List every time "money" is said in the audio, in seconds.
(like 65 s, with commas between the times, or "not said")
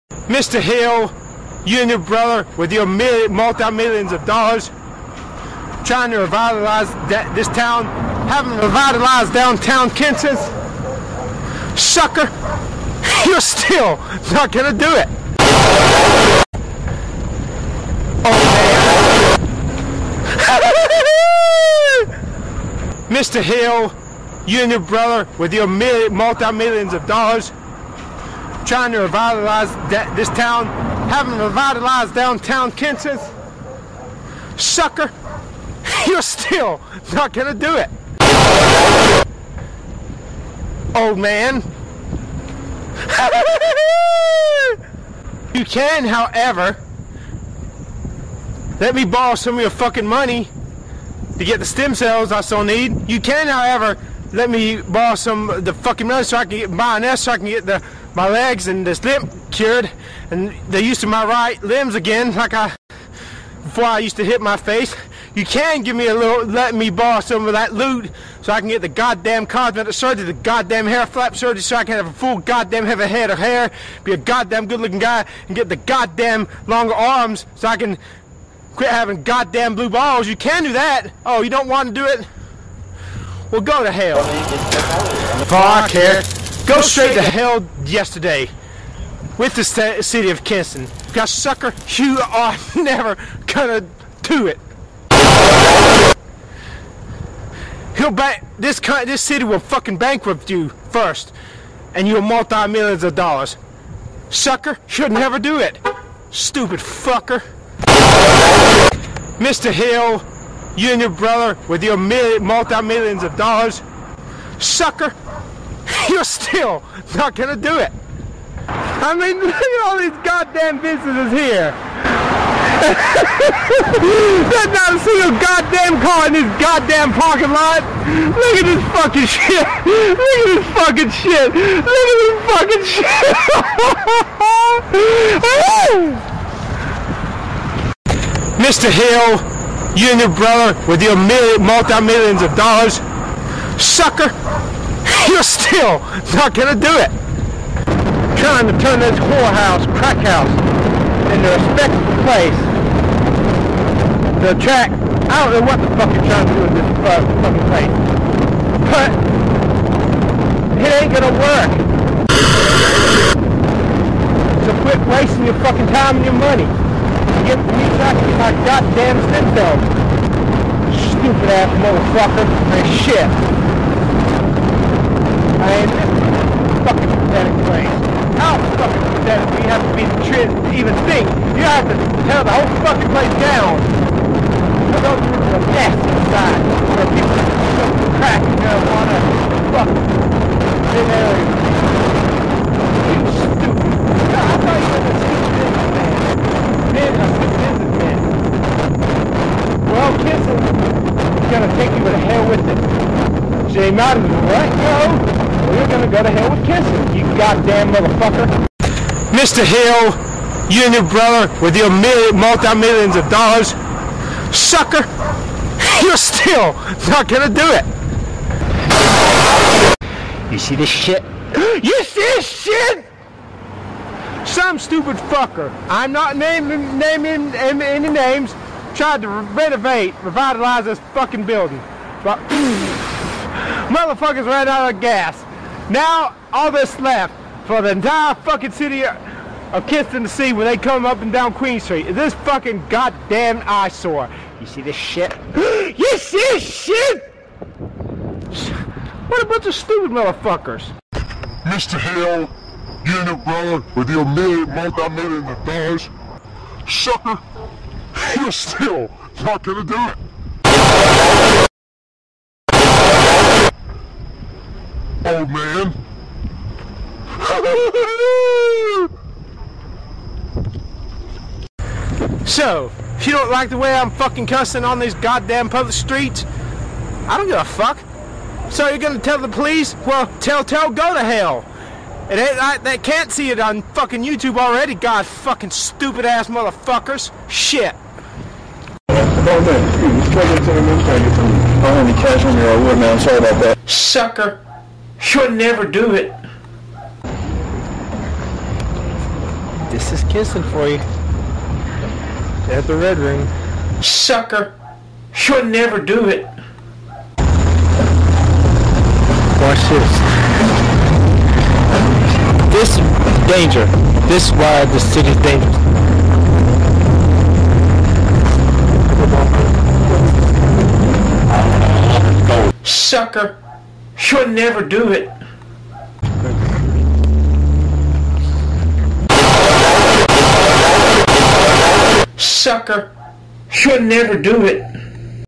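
50 s, 56 s, 166 s.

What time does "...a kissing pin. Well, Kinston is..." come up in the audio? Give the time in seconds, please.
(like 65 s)
197 s.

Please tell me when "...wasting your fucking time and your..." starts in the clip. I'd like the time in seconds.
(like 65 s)
165 s.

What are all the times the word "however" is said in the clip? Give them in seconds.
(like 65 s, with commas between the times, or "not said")
46 s, 53 s.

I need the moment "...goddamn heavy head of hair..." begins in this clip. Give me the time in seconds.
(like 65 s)
72 s.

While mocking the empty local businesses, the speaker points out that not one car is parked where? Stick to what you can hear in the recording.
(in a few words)
parking lot.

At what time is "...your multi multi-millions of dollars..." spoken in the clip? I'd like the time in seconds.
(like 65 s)
211 s.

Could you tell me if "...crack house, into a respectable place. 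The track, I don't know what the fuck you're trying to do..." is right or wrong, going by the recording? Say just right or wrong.
right.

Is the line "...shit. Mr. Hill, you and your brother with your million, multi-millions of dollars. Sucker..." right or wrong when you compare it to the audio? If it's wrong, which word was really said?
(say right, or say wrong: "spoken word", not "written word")
right.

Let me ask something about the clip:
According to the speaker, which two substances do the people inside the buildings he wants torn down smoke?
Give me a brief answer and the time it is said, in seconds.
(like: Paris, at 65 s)
crack and marijuana, at 188 s.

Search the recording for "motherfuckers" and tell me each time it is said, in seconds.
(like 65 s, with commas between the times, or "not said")
171 s, 207 s, 233 s, 250 s, 286 s.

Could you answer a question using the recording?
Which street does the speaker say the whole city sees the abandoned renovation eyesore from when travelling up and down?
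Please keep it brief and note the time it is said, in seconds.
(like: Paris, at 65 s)
Queen Street, at 241 s.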